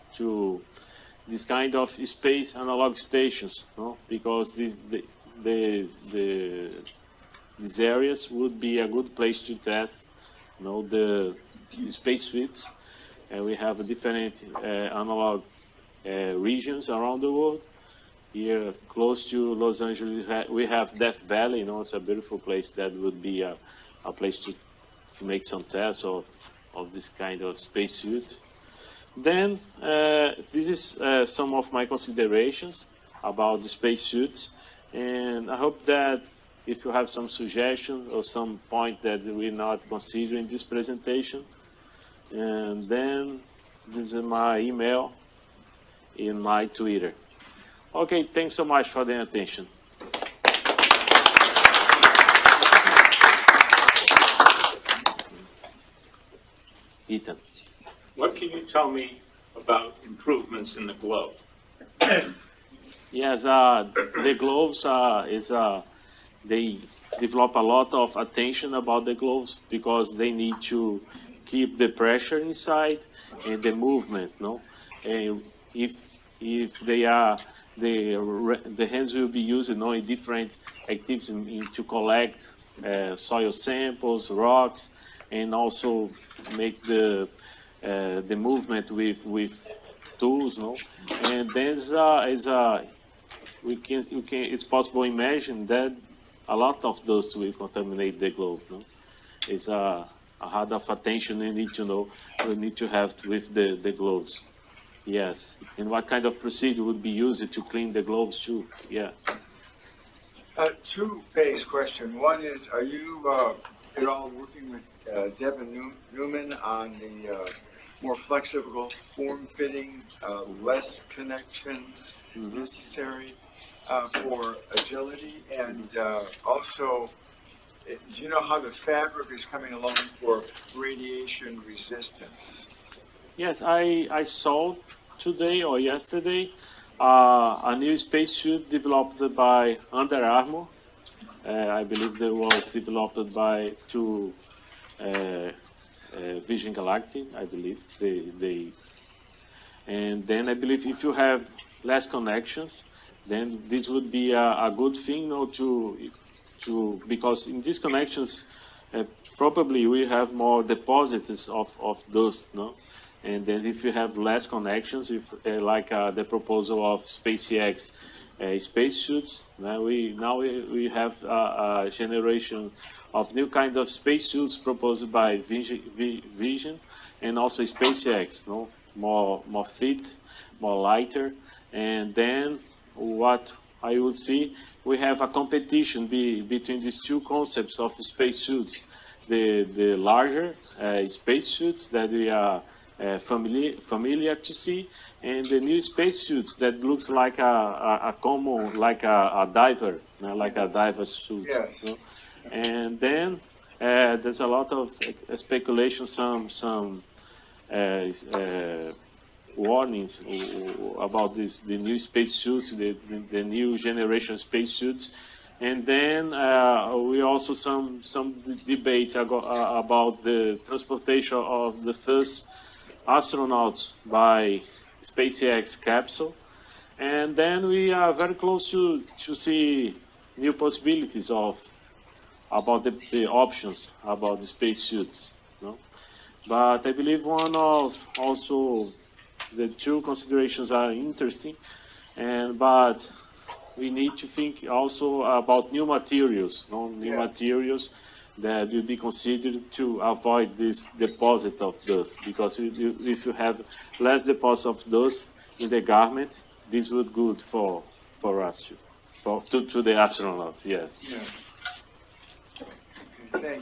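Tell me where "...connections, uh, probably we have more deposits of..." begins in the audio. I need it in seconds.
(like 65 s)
157 s.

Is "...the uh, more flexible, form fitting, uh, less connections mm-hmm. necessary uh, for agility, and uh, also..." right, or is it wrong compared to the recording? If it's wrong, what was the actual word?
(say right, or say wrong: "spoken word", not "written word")
right.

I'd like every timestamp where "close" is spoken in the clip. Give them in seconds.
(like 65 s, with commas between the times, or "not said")
18 s, 228 s.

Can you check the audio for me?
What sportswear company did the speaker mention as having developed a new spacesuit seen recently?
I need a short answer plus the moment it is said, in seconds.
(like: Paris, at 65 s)
Under Armour, at 139 s.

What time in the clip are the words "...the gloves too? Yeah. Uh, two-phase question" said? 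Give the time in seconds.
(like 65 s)
107 s.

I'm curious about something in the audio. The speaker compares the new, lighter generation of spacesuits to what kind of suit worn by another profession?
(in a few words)
diver suit.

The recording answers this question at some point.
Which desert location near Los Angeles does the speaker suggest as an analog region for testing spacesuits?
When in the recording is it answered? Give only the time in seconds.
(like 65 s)
20 s.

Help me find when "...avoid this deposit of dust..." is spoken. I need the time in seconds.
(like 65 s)
250 s.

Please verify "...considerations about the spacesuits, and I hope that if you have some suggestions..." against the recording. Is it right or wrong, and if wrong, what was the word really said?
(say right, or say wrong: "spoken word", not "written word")
right.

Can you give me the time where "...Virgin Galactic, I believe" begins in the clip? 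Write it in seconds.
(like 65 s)
146 s.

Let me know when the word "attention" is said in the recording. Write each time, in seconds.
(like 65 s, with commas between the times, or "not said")
49 s, 68 s, 100 s.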